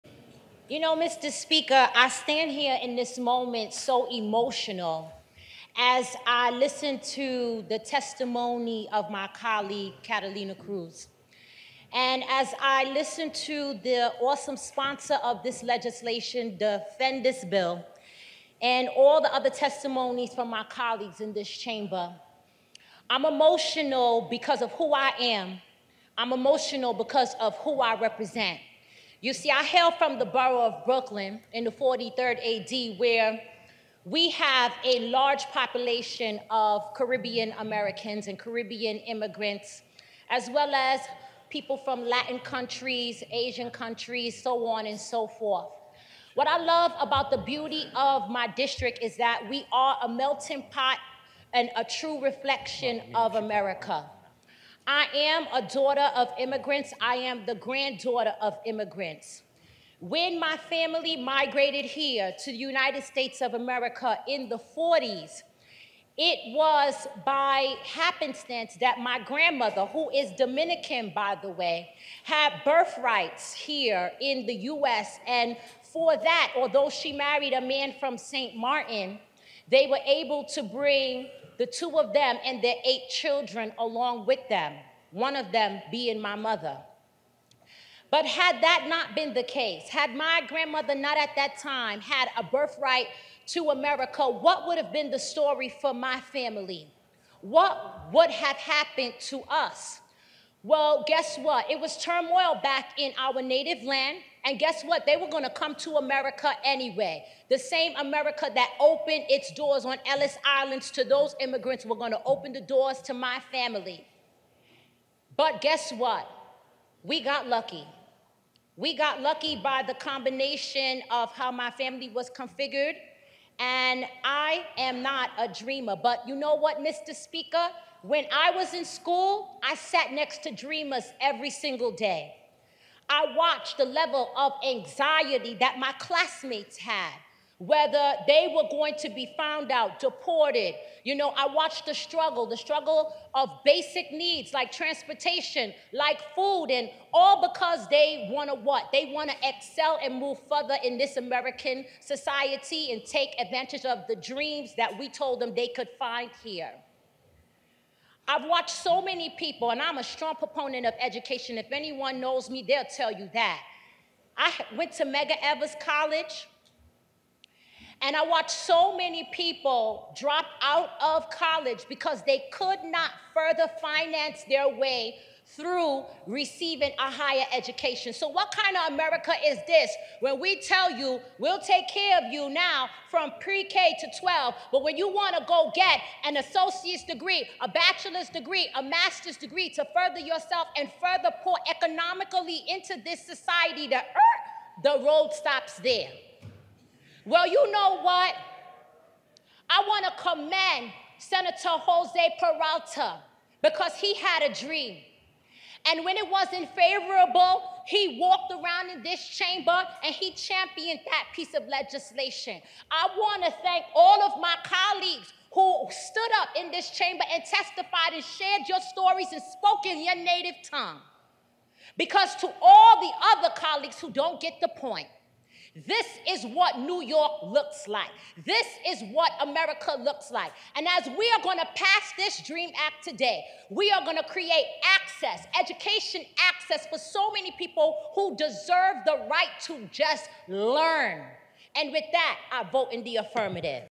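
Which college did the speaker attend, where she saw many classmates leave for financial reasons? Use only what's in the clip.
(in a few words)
Medgar Evers College.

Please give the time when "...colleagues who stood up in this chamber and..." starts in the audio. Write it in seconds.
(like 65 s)
214 s.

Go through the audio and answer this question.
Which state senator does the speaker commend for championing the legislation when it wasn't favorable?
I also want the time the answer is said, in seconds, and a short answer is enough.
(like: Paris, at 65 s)
Jose Peralta, at 201 s.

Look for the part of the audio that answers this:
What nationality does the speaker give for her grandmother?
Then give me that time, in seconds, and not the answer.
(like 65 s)
70 s.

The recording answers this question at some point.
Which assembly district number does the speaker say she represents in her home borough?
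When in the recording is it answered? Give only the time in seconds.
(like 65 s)
31 s.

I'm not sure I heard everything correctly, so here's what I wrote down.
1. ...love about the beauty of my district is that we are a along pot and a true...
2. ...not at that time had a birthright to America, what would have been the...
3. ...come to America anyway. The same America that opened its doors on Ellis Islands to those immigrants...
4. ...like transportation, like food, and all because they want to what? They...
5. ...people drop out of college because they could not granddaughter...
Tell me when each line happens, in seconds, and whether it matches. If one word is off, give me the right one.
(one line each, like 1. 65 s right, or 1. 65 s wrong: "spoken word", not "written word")
1. 46 s wrong: "melting", not "along"
2. 90 s right
3. 105 s right
4. 144 s right
5. 169 s wrong: "further", not "granddaughter".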